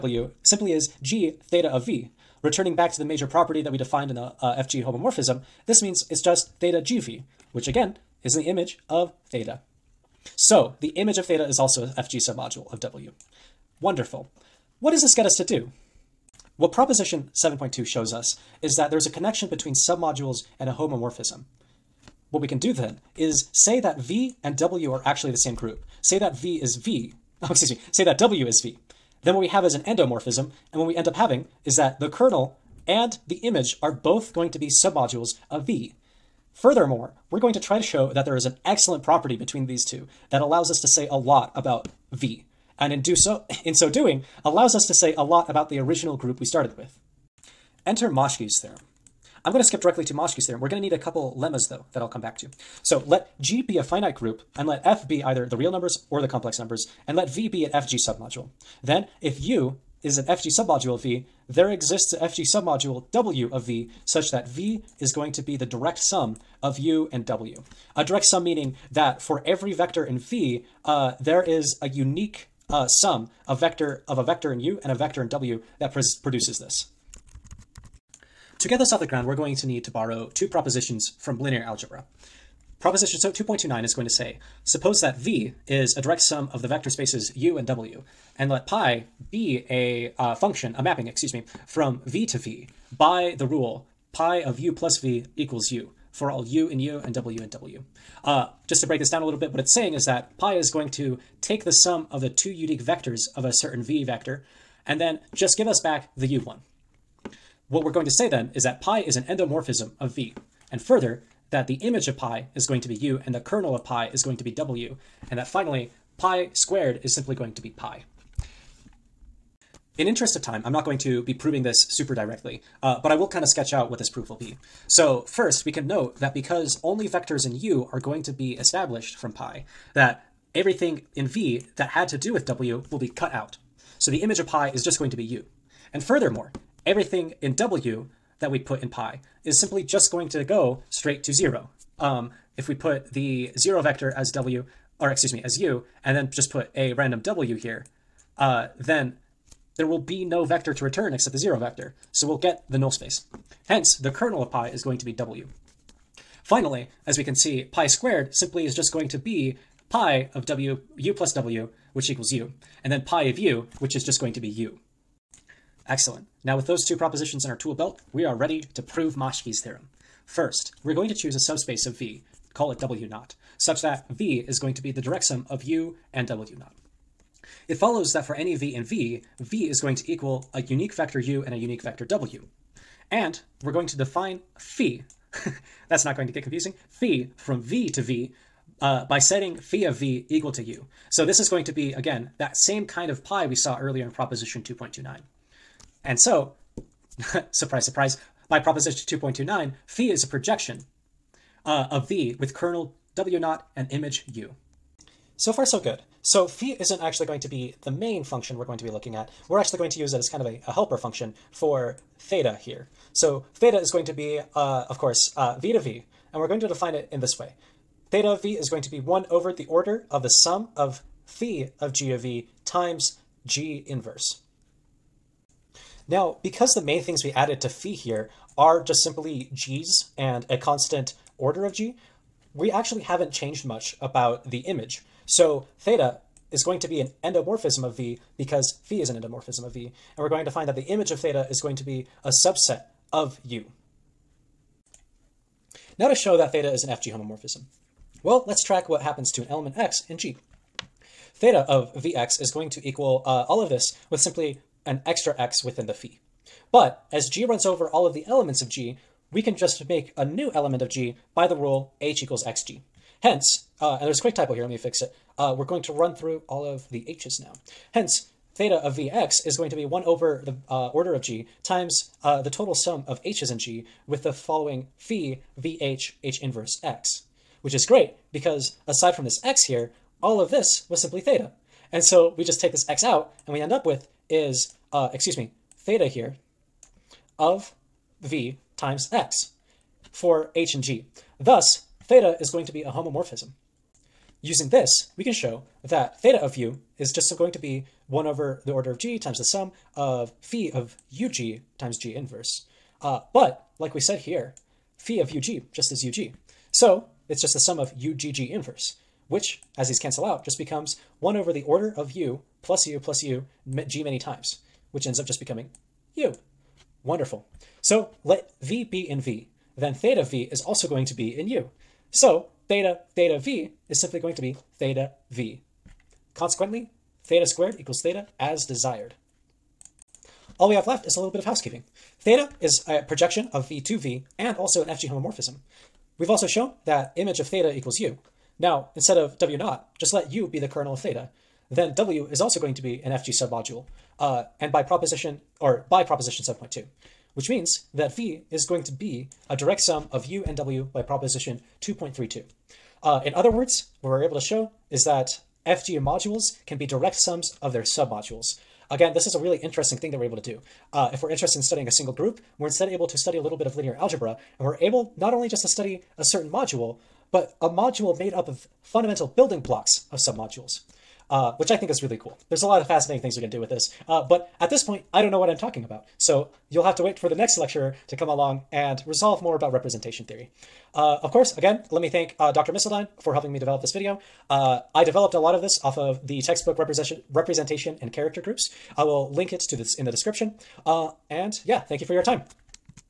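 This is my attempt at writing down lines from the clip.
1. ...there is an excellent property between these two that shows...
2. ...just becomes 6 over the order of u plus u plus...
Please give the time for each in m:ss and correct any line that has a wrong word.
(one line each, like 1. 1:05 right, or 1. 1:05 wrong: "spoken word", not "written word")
1. 0:38 wrong: "allows", not "shows"
2. 5:10 wrong: "1", not "6".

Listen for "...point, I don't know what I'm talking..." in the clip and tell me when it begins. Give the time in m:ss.
6:14.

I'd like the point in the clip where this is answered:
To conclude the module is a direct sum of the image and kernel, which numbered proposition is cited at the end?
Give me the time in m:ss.
5:51.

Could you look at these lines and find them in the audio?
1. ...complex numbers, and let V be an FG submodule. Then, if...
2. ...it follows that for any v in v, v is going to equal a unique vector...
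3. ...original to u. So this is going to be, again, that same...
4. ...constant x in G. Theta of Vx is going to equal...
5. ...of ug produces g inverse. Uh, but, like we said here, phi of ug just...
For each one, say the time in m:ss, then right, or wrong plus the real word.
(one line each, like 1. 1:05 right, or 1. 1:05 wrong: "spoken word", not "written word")
1. 0:56 right
2. 2:57 right
3. 3:10 wrong: "equal", not "original"
4. 4:09 wrong: "element", not "constant"
5. 5:00 wrong: "times", not "produces".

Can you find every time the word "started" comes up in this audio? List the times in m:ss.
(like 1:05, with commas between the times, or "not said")
0:46.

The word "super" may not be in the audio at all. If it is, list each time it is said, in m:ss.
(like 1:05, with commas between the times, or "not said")
2:01.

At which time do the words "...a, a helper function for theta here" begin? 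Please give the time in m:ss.
3:30.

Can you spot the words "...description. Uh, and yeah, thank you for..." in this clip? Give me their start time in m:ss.
6:30.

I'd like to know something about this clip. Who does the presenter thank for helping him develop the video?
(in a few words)
Dr. Misseldine.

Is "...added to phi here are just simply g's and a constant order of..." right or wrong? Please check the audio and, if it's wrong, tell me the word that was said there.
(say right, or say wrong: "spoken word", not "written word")
right.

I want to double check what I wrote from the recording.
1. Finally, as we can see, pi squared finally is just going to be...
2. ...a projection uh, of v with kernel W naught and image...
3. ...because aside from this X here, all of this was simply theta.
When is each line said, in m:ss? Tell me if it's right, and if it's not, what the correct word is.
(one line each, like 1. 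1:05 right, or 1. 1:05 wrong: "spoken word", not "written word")
1. 2:36 wrong: "simply", not "finally"
2. 3:20 right
3. 4:38 right.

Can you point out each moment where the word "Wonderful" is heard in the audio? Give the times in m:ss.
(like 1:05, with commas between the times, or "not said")
0:13, 5:17.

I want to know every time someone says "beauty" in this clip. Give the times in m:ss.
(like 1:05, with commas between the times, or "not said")
not said.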